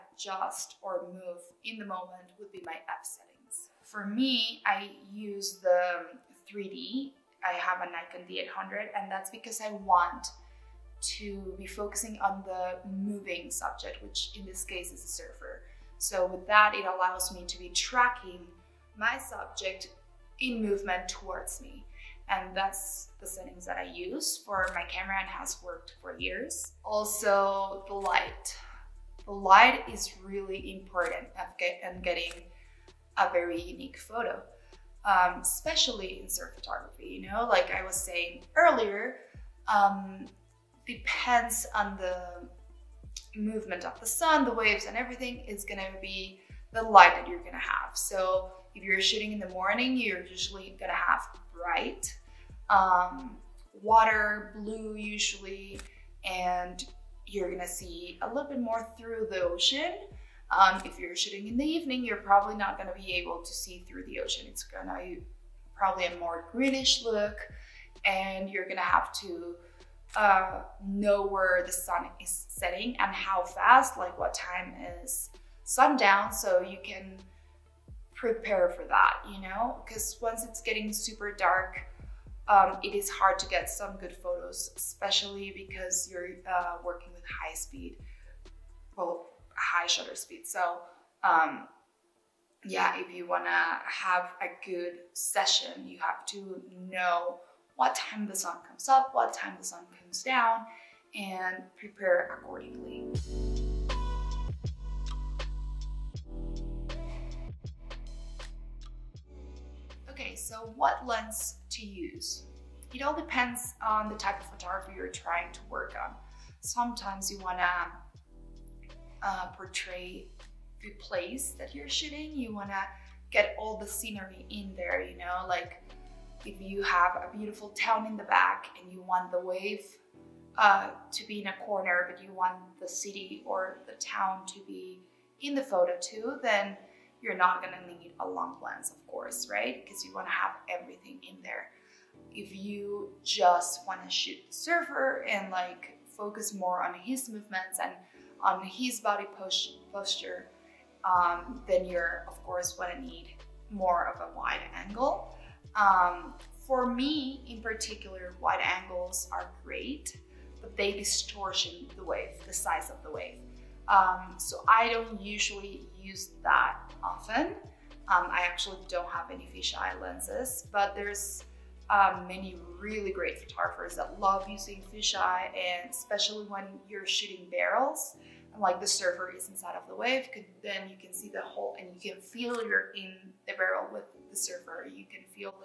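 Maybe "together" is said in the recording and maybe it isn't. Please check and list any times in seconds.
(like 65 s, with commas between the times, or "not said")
not said.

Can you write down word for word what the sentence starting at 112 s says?
It all depends on the type of photography you're trying to work on.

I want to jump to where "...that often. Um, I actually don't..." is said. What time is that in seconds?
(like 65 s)
166 s.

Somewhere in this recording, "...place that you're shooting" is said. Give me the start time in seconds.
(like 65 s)
120 s.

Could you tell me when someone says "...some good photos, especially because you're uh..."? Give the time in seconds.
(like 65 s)
83 s.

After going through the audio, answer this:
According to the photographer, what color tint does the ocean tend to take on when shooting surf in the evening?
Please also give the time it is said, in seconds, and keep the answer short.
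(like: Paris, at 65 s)
Greenish, at 66 s.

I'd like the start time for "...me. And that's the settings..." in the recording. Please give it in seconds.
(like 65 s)
21 s.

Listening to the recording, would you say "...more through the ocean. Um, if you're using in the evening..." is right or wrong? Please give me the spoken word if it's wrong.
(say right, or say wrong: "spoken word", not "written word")
wrong: "shooting", not "using".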